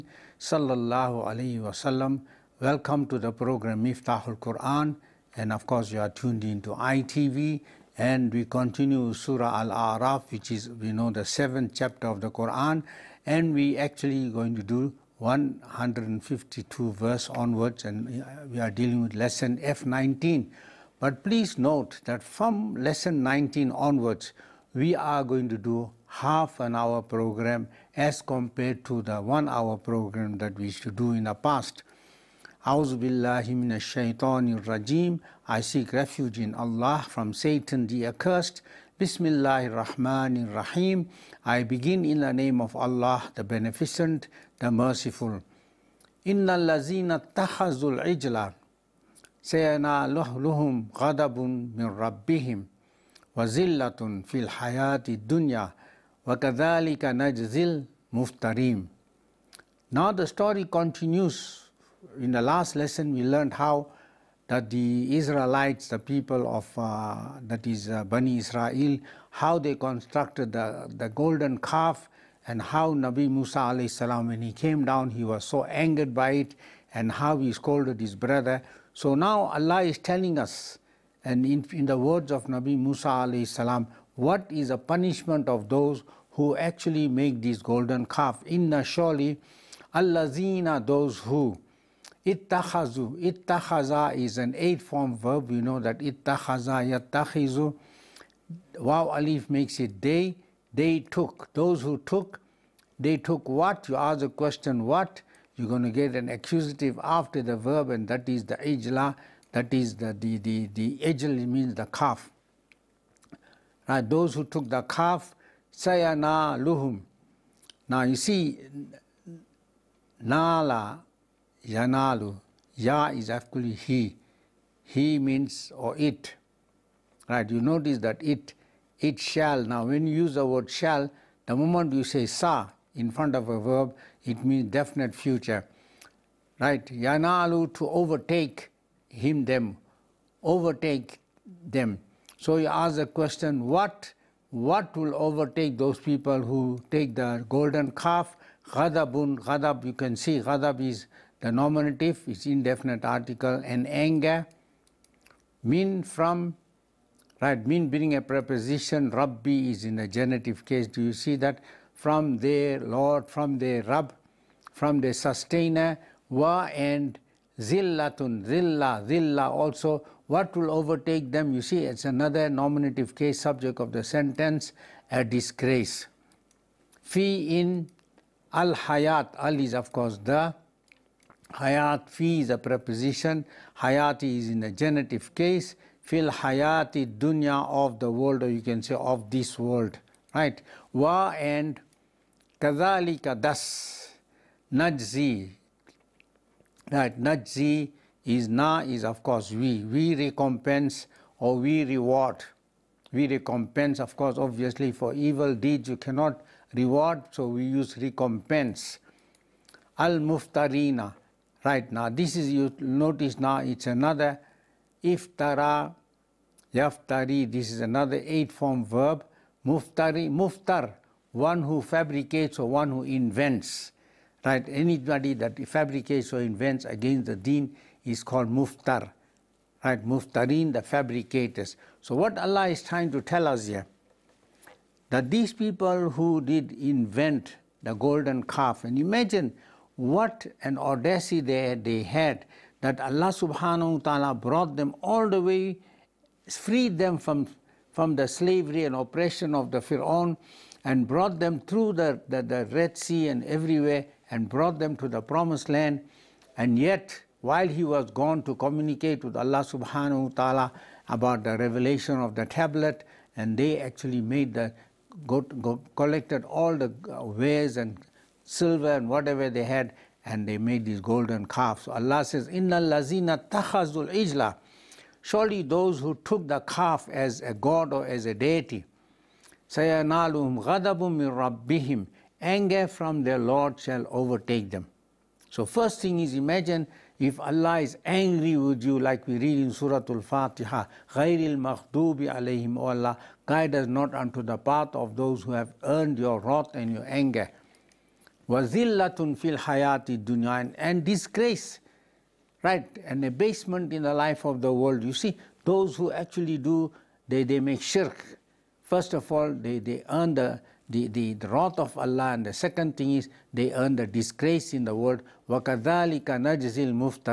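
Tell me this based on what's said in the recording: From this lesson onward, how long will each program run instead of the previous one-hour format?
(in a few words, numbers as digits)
Half an hour.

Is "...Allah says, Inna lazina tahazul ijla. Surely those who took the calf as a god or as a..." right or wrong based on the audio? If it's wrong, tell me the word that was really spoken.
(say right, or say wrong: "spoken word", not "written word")
right.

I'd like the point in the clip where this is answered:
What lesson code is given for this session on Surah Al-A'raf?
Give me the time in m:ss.
0:19.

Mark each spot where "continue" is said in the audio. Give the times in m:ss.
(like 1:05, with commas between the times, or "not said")
0:08, 1:00.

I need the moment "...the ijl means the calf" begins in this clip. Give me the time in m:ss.
1:50.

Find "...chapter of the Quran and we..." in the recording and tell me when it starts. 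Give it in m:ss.
0:11.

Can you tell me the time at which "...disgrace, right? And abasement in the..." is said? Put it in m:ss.
5:01.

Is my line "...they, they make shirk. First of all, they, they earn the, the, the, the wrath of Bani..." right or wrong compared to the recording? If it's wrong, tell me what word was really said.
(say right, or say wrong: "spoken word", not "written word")
wrong: "Allah", not "Bani".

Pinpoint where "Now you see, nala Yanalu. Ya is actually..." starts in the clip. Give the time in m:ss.
1:57.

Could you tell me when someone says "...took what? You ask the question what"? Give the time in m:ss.
1:43.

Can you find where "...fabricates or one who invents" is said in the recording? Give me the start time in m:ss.
3:41.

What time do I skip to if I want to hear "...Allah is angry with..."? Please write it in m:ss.
4:47.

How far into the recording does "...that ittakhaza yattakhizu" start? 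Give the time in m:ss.
1:35.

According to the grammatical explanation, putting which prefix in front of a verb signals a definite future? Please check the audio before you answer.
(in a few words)
sa.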